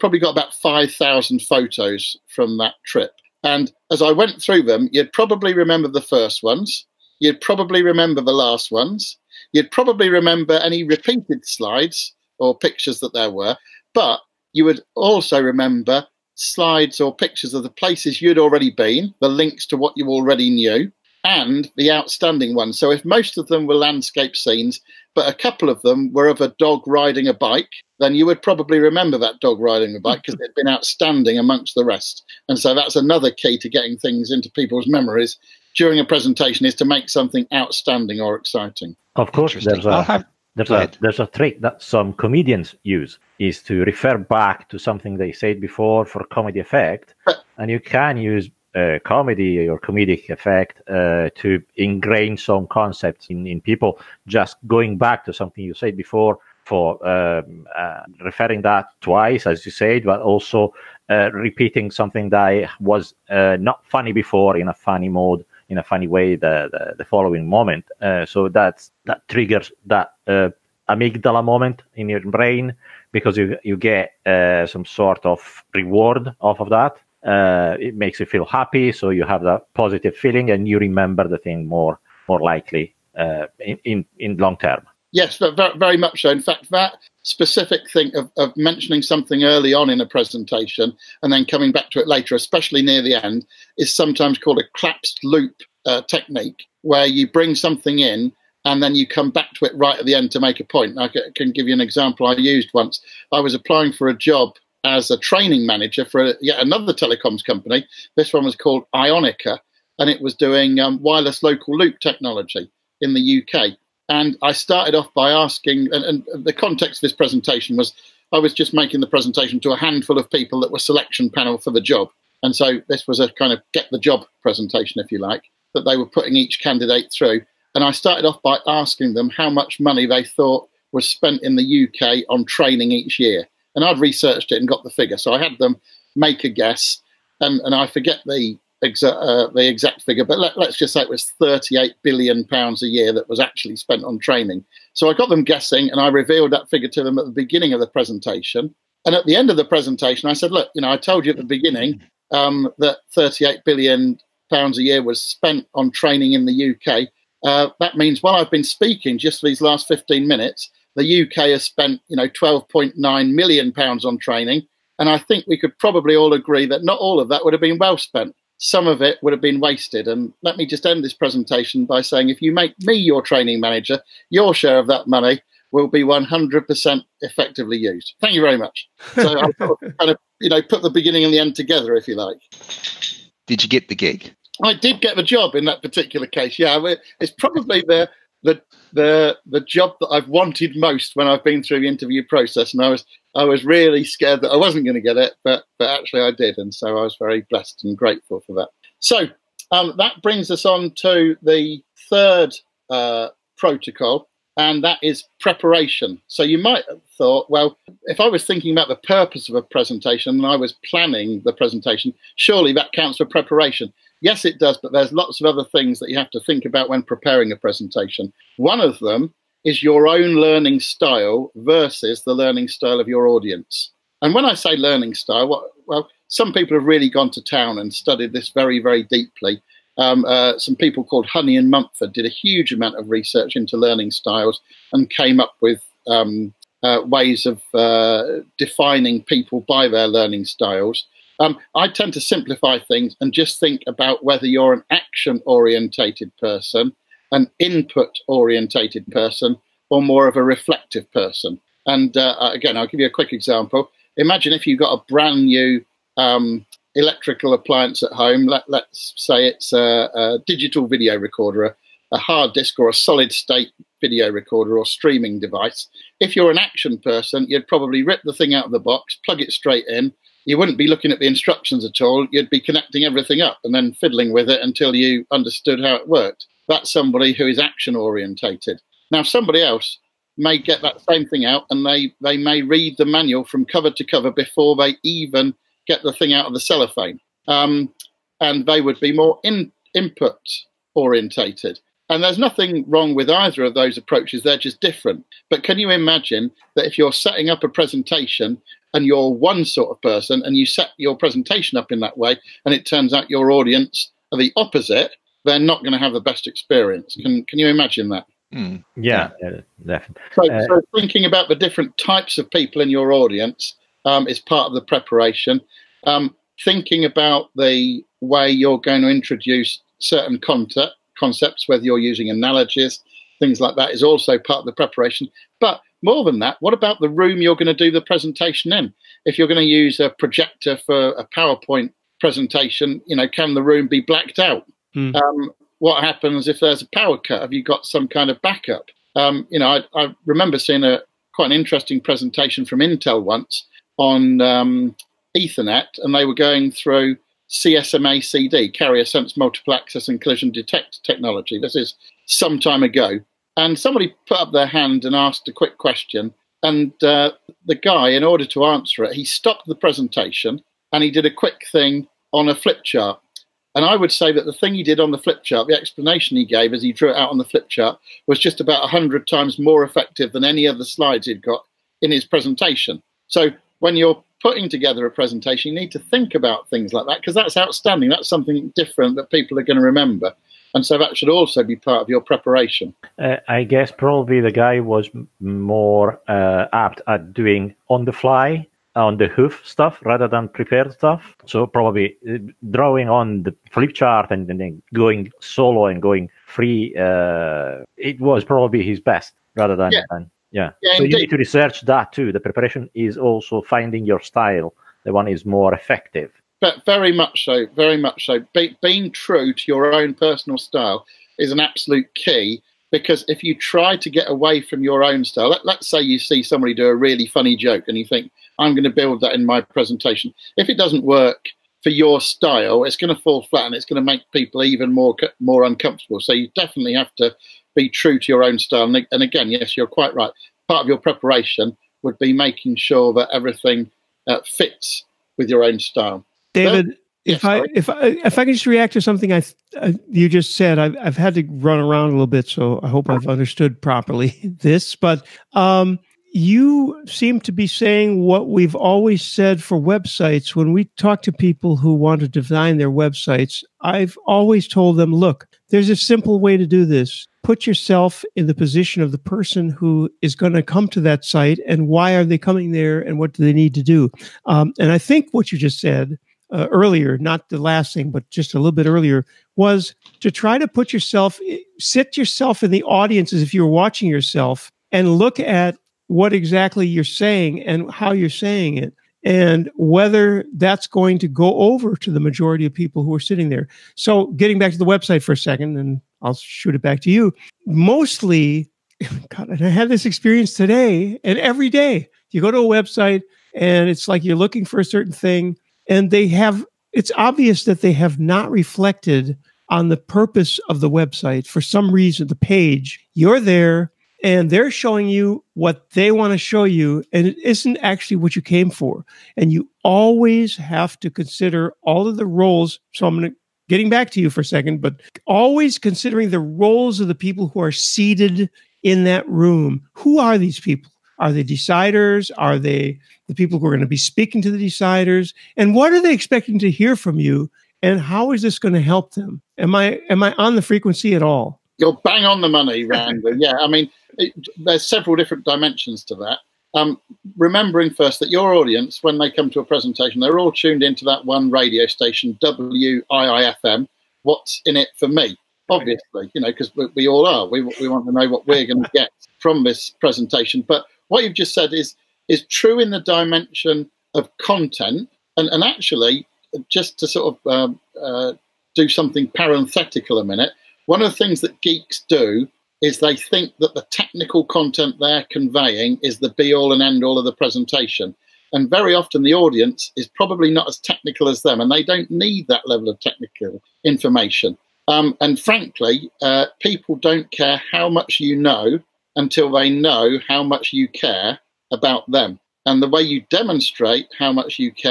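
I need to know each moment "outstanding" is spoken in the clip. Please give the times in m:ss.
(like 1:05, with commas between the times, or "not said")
0:21, 0:30, 0:37, 6:17.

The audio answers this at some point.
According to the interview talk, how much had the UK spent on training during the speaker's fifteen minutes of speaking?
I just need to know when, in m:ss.
2:42.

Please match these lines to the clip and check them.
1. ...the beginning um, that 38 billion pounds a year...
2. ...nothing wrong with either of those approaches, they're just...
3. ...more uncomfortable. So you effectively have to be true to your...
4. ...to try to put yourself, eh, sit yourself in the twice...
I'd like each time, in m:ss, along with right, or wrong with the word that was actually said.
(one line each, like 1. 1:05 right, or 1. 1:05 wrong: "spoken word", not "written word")
1. 2:31 right
2. 4:52 right
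3. 7:05 wrong: "definitely", not "effectively"
4. 7:50 wrong: "audience", not "twice".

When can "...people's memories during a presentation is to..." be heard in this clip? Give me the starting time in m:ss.
0:34.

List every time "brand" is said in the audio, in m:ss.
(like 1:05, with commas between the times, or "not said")
4:15.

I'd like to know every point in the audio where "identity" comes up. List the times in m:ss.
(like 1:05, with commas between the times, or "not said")
not said.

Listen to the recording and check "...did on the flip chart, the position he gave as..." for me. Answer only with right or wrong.
wrong.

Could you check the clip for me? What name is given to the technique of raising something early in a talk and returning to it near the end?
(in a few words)
Collapsed loop.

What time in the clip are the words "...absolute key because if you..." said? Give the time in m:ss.
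6:51.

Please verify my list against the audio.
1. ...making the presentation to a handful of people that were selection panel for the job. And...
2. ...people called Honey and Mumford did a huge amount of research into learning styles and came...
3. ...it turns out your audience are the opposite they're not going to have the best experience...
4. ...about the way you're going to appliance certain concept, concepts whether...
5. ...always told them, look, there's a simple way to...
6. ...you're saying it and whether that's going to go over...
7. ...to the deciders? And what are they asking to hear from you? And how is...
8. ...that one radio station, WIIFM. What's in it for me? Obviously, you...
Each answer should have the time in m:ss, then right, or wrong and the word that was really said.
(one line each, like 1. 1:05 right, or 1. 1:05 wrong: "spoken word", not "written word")
1. 1:58 right
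2. 3:50 right
3. 5:02 right
4. 5:17 wrong: "introduce", not "appliance"
5. 7:34 right
6. 7:58 right
7. 8:44 wrong: "expecting", not "asking"
8. 9:01 right.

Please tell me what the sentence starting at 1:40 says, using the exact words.
I can give you an example I used once.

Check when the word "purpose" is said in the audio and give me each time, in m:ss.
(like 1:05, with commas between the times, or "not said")
3:28, 8:19.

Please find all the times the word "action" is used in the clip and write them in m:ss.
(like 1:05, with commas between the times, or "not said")
4:04, 4:26, 4:37.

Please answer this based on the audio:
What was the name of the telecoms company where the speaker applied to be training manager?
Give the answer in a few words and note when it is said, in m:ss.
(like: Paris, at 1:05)
Ionica, at 1:48.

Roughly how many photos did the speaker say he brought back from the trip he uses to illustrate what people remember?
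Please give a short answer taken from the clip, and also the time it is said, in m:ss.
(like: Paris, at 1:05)
5,000, at 0:00.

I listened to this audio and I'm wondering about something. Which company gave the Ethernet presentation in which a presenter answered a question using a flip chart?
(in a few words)
Intel.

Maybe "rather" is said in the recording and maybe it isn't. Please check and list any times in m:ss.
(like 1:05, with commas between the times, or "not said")
6:30, 6:39.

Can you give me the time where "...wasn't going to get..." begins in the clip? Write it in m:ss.
3:14.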